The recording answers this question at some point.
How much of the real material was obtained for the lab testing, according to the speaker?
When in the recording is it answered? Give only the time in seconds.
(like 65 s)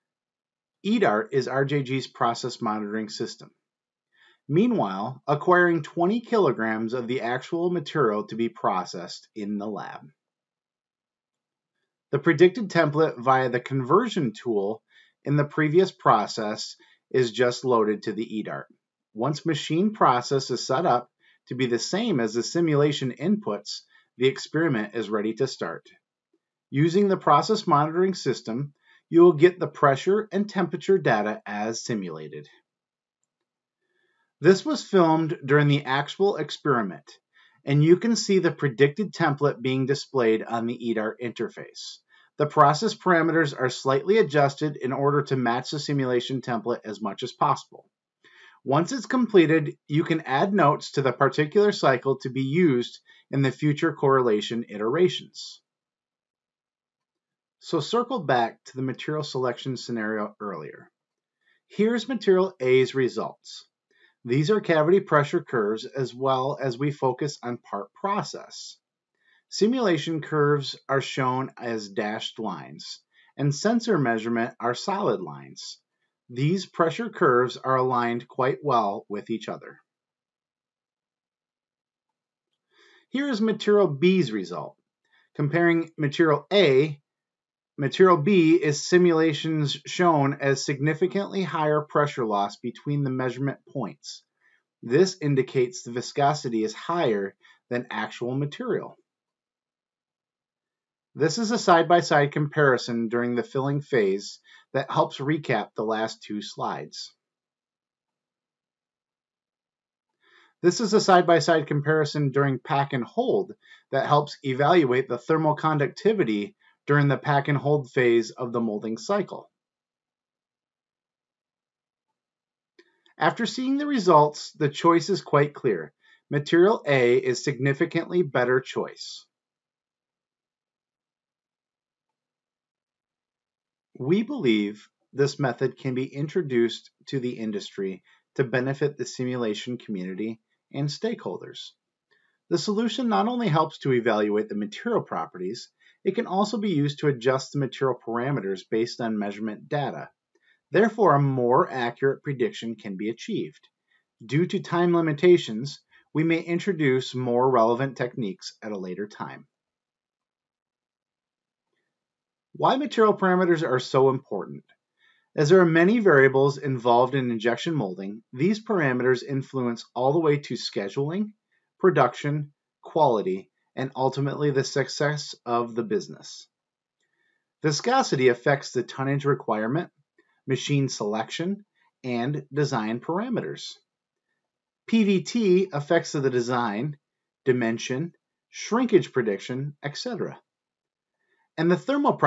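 5 s.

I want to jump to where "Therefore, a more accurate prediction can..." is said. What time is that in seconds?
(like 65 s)
150 s.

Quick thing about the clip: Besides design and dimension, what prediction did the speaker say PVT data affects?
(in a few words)
Shrinkage prediction.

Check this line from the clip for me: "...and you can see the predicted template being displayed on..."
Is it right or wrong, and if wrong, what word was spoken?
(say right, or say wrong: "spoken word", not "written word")
right.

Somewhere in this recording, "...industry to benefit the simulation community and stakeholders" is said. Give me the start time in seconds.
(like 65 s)
137 s.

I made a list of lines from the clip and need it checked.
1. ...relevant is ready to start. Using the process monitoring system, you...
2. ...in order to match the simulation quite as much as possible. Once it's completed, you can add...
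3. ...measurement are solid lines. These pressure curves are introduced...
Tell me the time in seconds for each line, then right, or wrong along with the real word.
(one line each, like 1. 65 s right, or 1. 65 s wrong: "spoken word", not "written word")
1. 24 s wrong: "experiment", not "relevant"
2. 44 s wrong: "template", not "quite"
3. 73 s wrong: "aligned", not "introduced".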